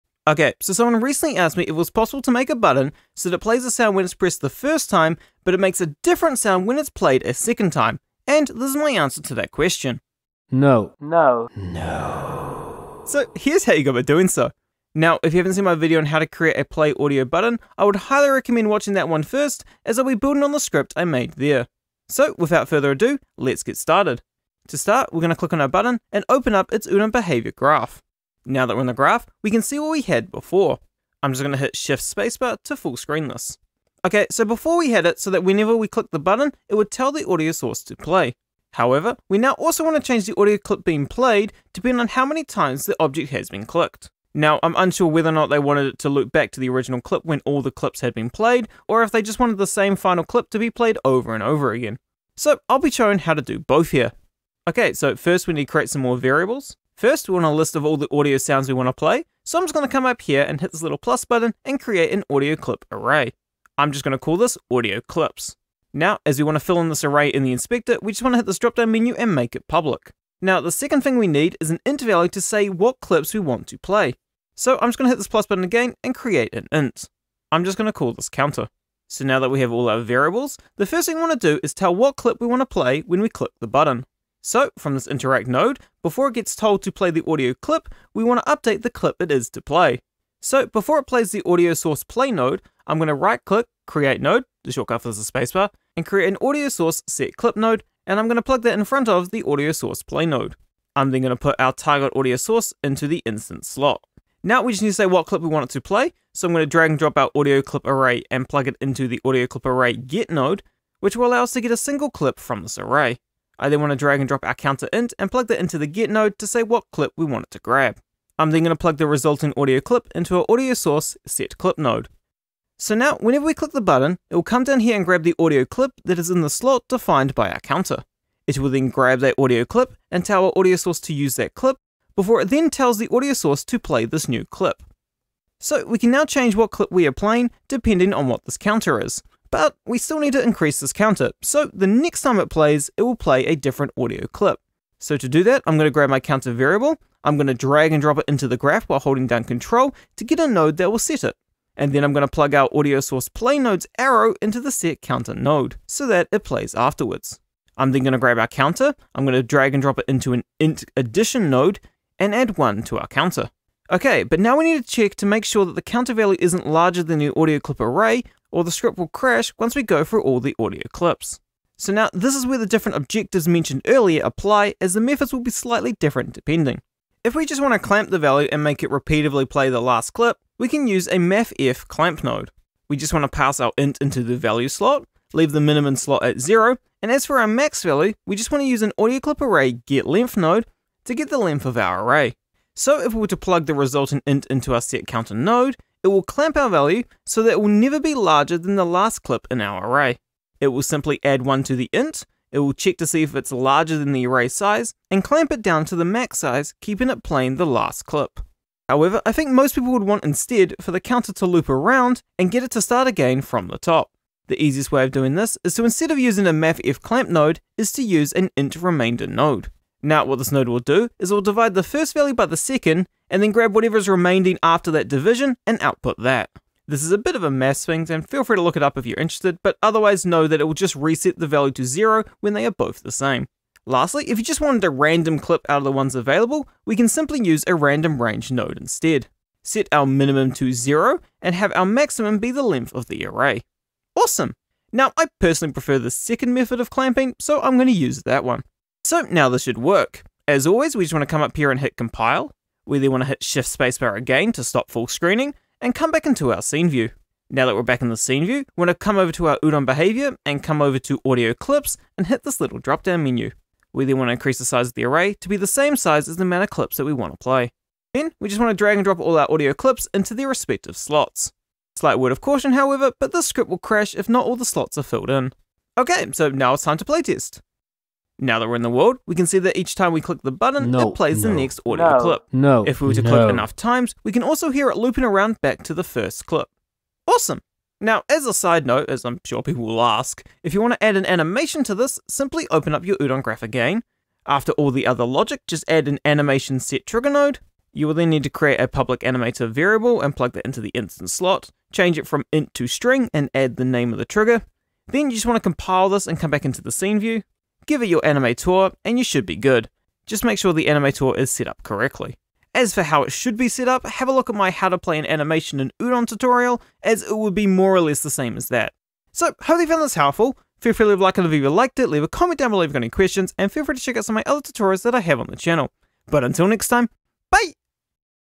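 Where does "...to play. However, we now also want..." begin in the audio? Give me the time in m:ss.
0:37.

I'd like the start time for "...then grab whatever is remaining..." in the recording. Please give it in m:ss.
3:43.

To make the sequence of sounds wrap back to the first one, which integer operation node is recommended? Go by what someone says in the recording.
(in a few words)
int remainder.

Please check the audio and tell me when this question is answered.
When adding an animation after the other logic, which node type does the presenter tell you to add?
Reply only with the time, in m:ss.
4:56.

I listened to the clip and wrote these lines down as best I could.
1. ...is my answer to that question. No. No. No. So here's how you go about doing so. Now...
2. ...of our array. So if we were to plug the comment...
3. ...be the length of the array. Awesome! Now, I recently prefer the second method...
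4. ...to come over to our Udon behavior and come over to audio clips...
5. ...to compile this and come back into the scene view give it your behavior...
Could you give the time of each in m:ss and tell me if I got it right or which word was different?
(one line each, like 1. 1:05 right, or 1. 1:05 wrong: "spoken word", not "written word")
1. 0:08 right
2. 3:11 wrong: "resultant", not "comment"
3. 4:02 wrong: "personally", not "recently"
4. 4:18 right
5. 5:05 wrong: "animator", not "behavior".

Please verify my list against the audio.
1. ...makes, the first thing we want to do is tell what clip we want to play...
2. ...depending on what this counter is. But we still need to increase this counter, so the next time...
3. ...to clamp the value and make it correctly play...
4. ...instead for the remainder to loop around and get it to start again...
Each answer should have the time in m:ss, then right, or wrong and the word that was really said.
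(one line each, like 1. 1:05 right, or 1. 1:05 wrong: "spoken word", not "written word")
1. 1:20 wrong: "variables", not "makes"
2. 2:17 right
3. 2:57 wrong: "repeatedly", not "correctly"
4. 3:30 wrong: "counter", not "remainder".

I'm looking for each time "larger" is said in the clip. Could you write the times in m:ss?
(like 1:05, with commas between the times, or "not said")
2:46, 3:18, 3:23.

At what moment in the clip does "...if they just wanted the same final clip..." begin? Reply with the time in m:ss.
0:49.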